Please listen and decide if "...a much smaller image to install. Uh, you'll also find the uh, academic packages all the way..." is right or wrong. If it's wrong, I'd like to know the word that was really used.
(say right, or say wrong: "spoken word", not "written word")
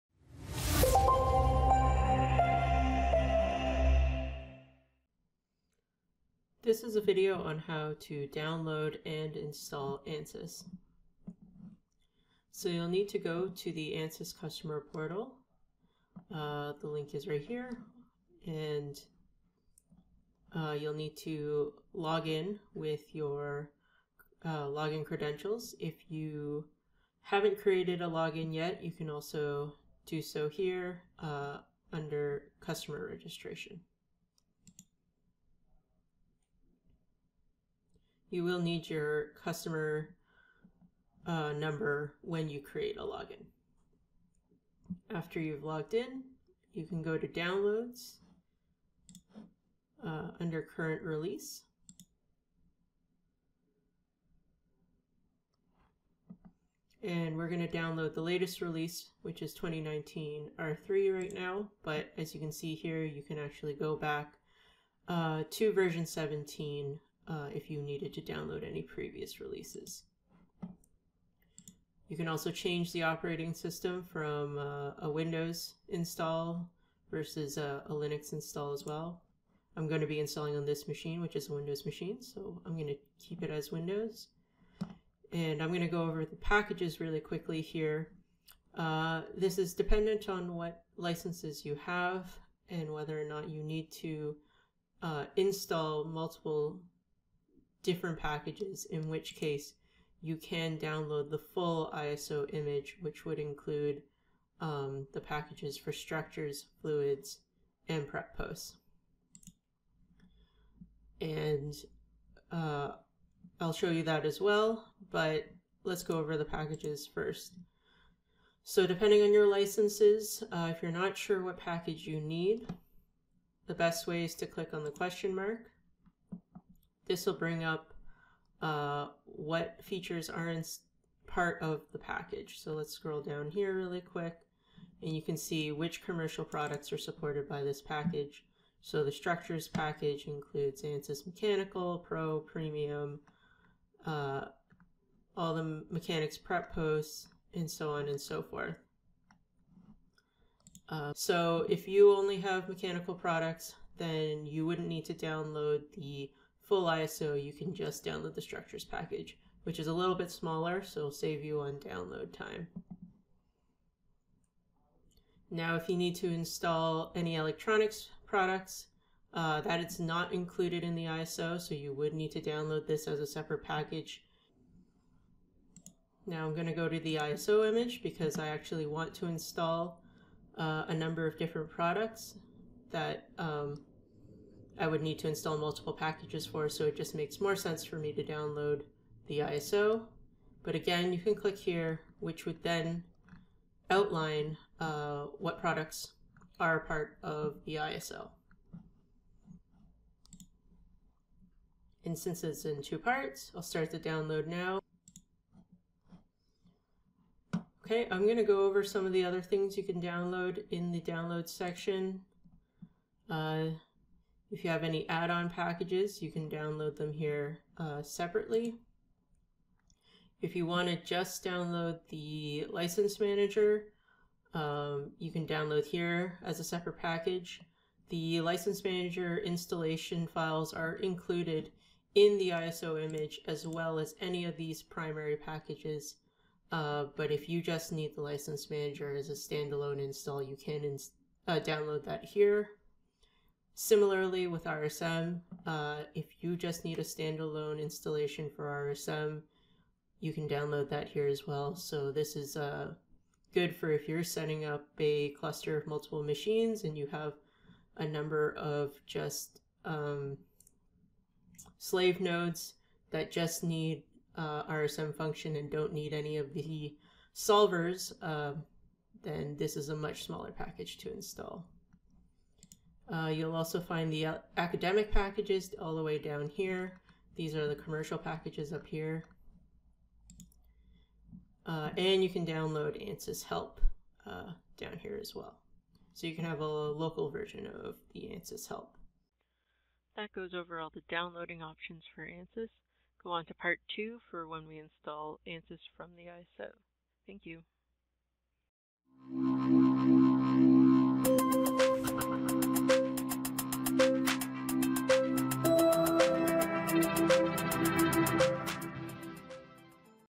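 wrong: "package", not "image".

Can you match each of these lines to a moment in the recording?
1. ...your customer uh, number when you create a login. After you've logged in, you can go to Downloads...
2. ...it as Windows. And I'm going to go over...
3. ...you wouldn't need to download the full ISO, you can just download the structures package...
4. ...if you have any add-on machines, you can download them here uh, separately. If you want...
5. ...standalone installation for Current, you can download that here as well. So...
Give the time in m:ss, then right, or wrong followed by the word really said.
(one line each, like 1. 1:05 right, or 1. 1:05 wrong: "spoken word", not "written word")
1. 0:38 right
2. 1:23 right
3. 2:34 right
4. 3:34 wrong: "packages", not "machines"
5. 4:07 wrong: "RSM", not "Current".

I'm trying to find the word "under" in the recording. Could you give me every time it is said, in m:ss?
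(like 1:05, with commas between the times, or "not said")
0:31, 0:50.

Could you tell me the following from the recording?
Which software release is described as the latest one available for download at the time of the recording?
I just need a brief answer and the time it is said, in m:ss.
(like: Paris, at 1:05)
2019 R3, at 0:59.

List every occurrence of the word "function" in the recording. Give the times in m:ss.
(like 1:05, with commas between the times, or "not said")
4:25.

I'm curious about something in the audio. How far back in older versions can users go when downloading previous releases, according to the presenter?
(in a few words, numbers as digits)
version 17.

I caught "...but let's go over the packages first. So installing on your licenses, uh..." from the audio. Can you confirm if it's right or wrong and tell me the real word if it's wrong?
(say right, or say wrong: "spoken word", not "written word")
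wrong: "depending", not "installing".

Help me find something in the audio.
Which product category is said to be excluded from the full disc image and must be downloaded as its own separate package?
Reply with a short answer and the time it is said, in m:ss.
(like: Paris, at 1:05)
electronics, at 2:47.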